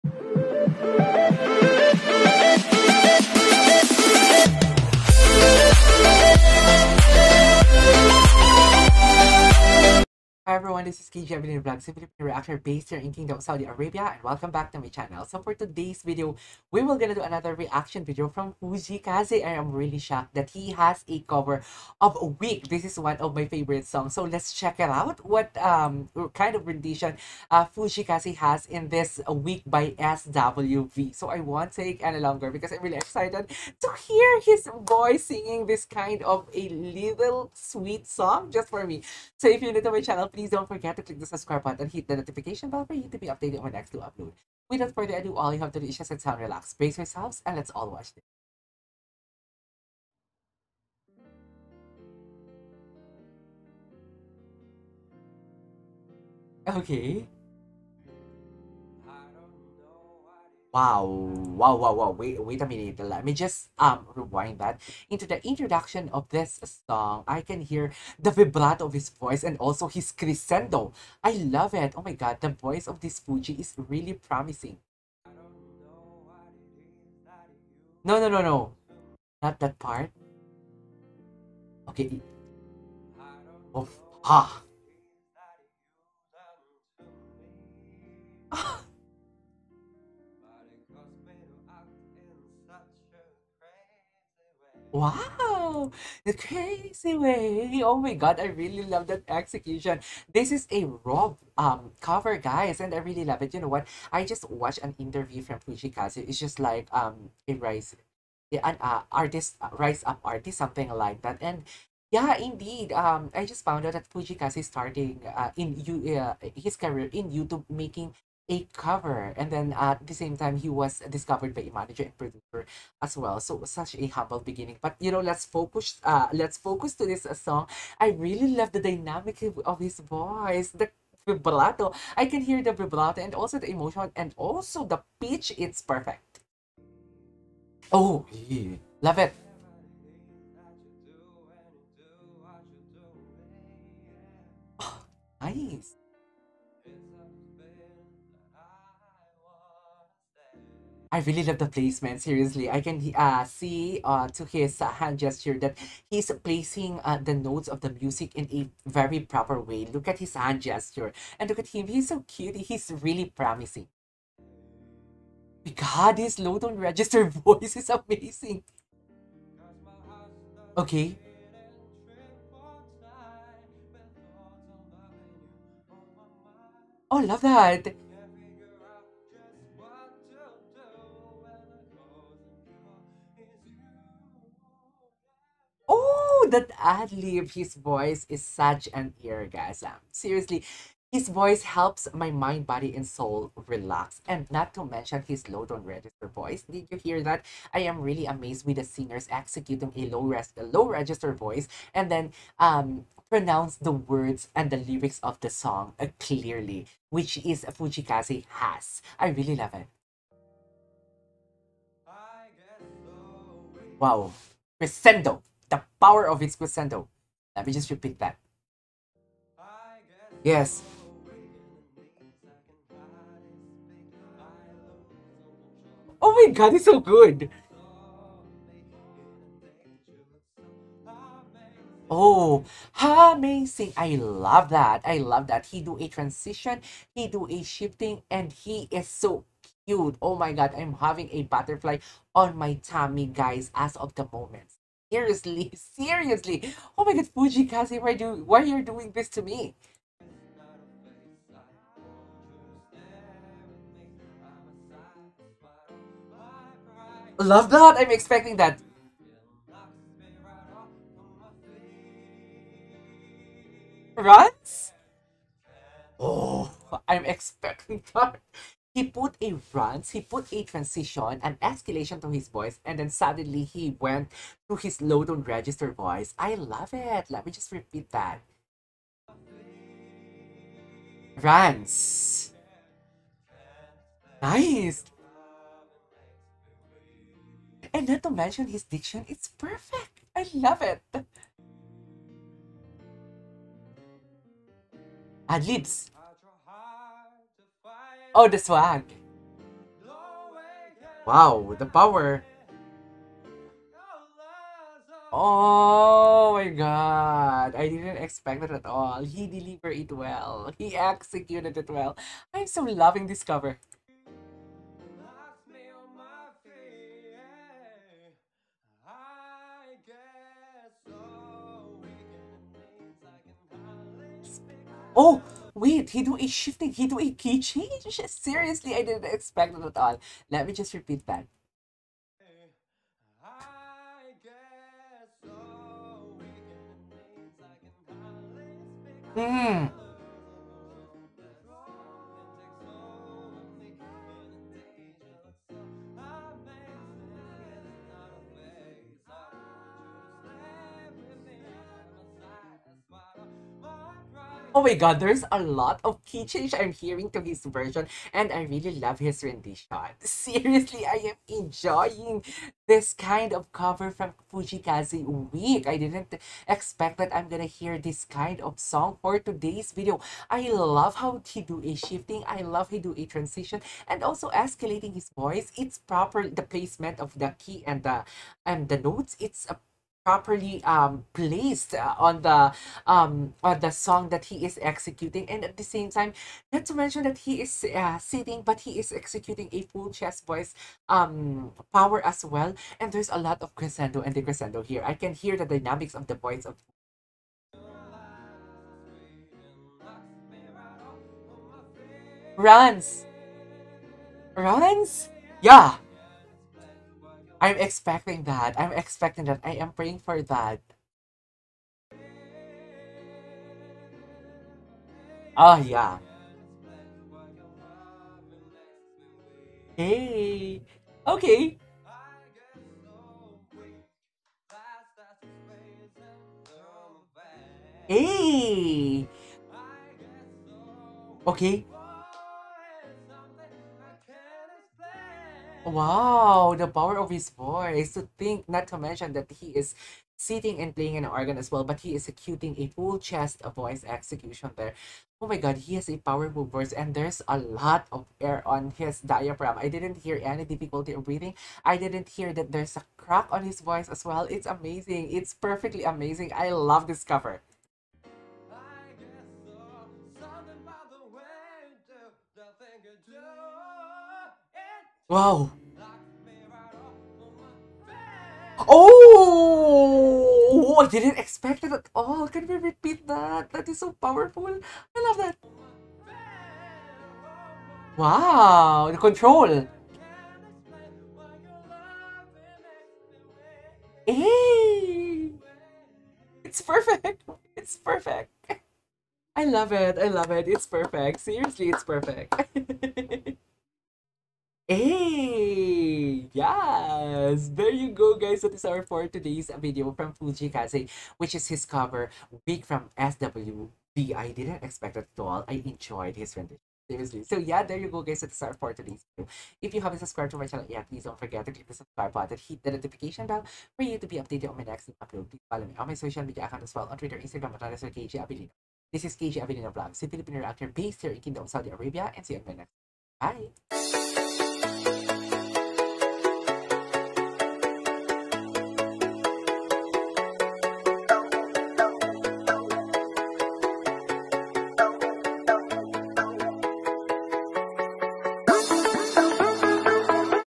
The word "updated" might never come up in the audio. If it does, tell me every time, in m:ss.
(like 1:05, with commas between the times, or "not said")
0:43, 8:34.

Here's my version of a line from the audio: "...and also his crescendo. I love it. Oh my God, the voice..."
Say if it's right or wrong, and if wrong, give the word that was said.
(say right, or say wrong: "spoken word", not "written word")
right.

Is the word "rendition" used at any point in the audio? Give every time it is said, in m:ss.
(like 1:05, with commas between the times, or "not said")
0:26, 5:59, 8:26.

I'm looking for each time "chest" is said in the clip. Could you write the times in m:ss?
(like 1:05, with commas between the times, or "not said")
6:30, 7:23.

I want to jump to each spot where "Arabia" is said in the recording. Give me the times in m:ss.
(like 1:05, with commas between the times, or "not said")
0:13, 8:41.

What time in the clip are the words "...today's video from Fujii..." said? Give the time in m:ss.
8:19.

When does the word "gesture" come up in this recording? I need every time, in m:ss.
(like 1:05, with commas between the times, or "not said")
2:35, 2:40.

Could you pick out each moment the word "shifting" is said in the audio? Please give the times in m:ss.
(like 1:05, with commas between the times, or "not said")
3:57, 5:26, 6:11.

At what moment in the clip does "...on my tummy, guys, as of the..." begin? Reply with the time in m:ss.
4:02.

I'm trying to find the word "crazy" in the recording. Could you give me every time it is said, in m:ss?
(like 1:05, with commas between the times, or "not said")
1:36.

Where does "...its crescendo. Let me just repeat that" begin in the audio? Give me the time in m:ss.
3:36.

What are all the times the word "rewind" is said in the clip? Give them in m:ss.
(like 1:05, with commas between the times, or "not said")
1:04.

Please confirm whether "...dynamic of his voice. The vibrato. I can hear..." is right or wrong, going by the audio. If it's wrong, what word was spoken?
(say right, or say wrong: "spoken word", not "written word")
right.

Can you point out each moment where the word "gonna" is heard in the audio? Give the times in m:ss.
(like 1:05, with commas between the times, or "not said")
0:16, 6:07.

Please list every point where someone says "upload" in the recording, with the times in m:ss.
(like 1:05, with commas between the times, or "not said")
0:43, 8:35.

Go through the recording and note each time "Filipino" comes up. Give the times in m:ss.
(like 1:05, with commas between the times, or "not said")
8:40.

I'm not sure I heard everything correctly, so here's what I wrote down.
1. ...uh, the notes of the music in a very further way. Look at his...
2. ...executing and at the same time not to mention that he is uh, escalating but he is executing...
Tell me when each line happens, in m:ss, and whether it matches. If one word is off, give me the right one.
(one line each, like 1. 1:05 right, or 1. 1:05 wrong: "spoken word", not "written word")
1. 2:37 wrong: "proper", not "further"
2. 6:24 wrong: "sitting", not "escalating".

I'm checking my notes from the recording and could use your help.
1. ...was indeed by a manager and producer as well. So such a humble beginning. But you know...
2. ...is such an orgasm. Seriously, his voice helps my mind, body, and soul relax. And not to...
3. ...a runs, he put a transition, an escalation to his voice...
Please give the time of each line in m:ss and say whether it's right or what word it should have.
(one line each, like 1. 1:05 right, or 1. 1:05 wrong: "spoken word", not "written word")
1. 2:00 wrong: "discovered", not "indeed"
2. 3:08 right
3. 4:29 right.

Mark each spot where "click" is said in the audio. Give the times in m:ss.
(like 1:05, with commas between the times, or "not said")
0:41, 8:31.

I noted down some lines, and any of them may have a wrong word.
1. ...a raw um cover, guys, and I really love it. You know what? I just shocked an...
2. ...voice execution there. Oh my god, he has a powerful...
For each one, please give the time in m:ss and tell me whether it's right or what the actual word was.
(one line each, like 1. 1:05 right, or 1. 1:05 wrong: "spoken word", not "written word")
1. 1:40 wrong: "watched", not "shocked"
2. 7:23 right.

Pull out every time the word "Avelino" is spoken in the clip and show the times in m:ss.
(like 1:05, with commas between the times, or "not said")
0:11, 8:39.